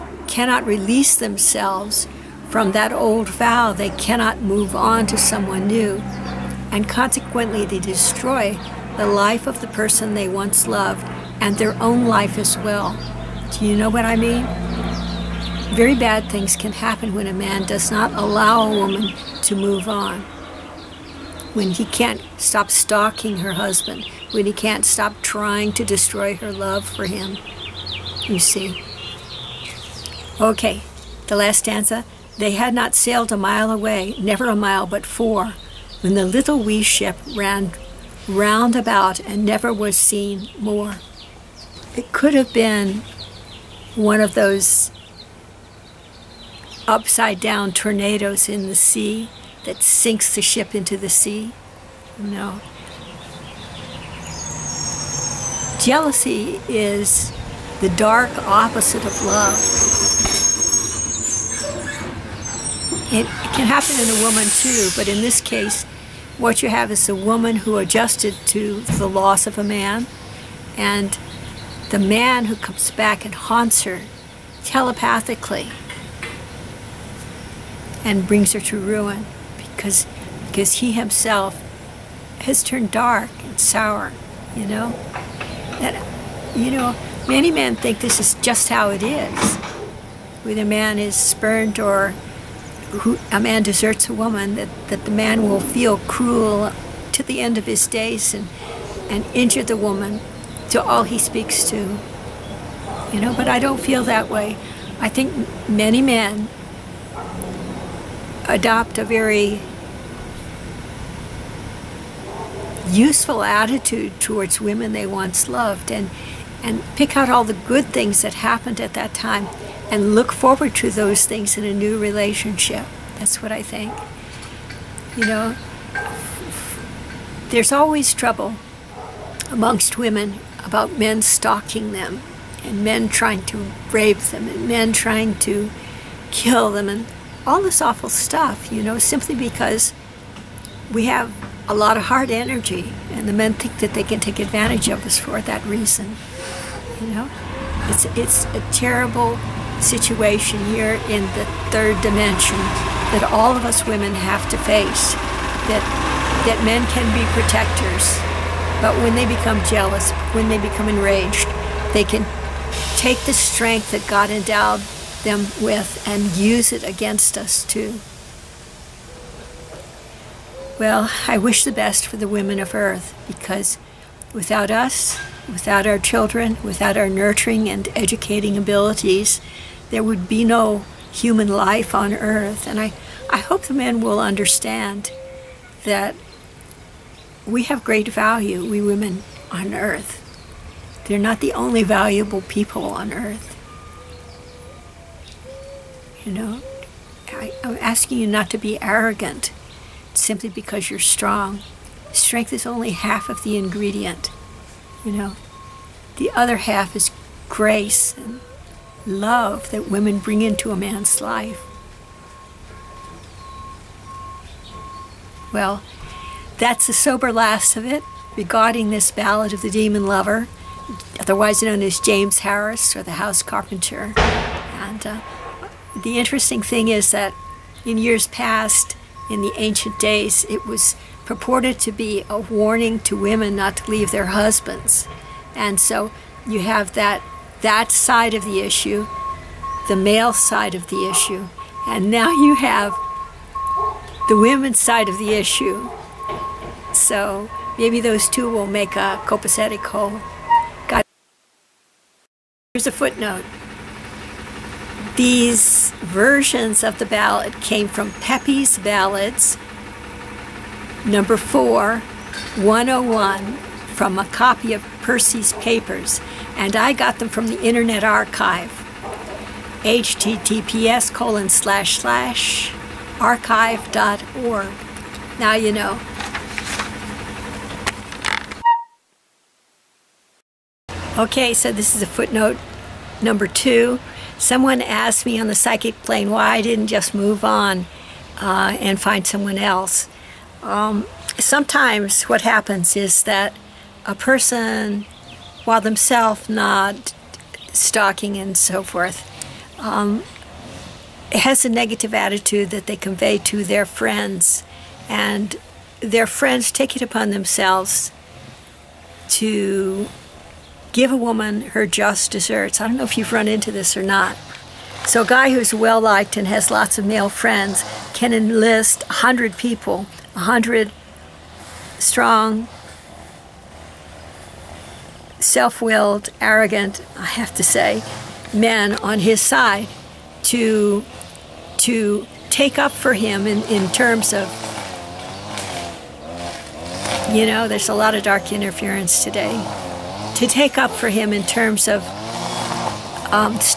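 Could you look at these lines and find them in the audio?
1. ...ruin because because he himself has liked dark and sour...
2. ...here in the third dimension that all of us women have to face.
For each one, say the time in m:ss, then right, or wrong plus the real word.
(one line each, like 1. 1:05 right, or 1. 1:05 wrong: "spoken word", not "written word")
1. 1:18 wrong: "turned", not "liked"
2. 2:30 right.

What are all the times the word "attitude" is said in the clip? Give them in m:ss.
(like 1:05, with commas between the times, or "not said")
1:53, 5:02.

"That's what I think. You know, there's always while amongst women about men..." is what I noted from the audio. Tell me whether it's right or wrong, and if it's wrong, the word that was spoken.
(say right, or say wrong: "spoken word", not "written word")
wrong: "trouble", not "while".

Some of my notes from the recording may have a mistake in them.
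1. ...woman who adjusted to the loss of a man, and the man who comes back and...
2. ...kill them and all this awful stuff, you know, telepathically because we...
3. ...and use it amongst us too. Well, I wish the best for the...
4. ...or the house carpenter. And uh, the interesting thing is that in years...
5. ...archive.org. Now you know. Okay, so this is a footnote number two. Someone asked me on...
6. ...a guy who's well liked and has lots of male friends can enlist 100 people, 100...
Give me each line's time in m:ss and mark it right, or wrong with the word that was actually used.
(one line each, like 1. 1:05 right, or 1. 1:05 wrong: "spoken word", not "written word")
1. 1:07 right
2. 2:16 wrong: "simply", not "telepathically"
3. 2:46 wrong: "against", not "amongst"
4. 3:42 right
5. 4:33 right
6. 5:15 right.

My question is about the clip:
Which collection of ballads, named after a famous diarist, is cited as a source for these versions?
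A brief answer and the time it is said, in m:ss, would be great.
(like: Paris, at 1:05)
Pepys' Ballads, at 4:18.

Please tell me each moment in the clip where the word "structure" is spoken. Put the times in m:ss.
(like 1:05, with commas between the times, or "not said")
not said.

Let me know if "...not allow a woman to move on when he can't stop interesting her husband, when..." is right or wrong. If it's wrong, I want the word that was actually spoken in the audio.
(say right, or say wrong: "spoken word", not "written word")
wrong: "stalking", not "interesting".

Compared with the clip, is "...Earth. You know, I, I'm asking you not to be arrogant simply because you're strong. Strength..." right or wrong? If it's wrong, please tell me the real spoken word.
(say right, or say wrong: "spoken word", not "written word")
right.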